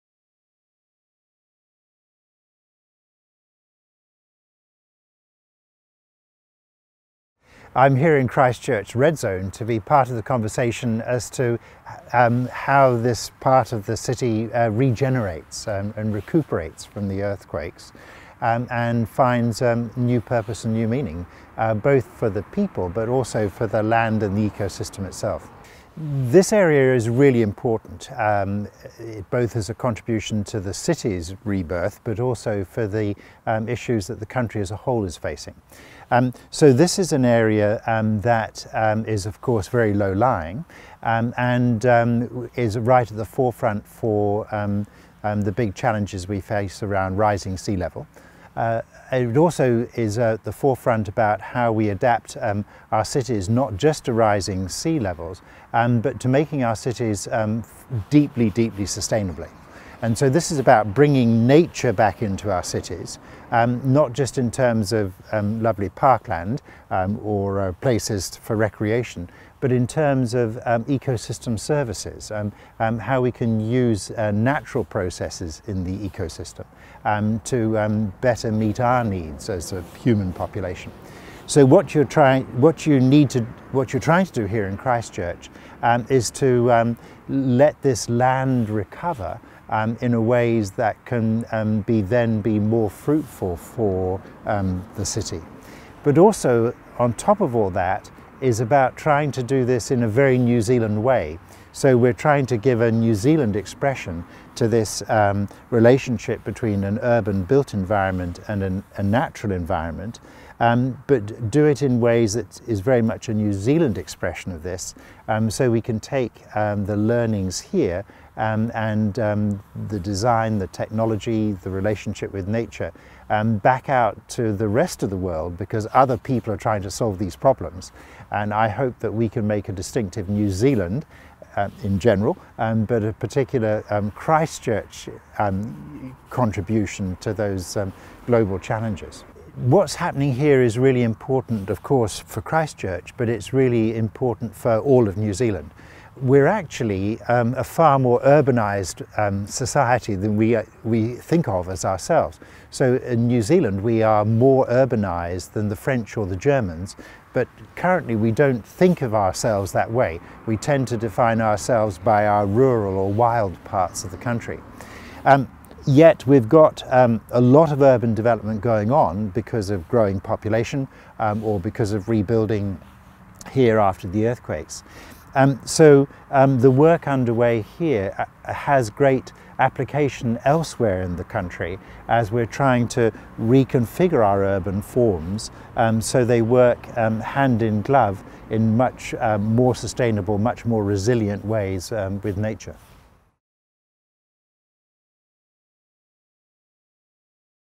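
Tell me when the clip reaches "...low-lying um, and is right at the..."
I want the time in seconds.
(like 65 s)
39 s.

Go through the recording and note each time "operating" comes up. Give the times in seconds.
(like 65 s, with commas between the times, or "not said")
not said.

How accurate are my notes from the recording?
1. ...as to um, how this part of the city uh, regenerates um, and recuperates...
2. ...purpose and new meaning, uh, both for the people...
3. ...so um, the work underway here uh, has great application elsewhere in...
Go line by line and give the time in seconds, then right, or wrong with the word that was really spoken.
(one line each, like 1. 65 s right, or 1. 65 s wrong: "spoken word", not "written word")
1. 11 s right
2. 20 s right
3. 175 s right.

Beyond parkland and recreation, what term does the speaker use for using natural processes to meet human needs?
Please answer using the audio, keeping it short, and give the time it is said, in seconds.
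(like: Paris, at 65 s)
ecosystem services, at 70 s.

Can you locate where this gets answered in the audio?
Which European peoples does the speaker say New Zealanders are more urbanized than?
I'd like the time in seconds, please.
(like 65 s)
155 s.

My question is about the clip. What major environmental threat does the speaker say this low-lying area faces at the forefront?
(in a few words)
rising sea level.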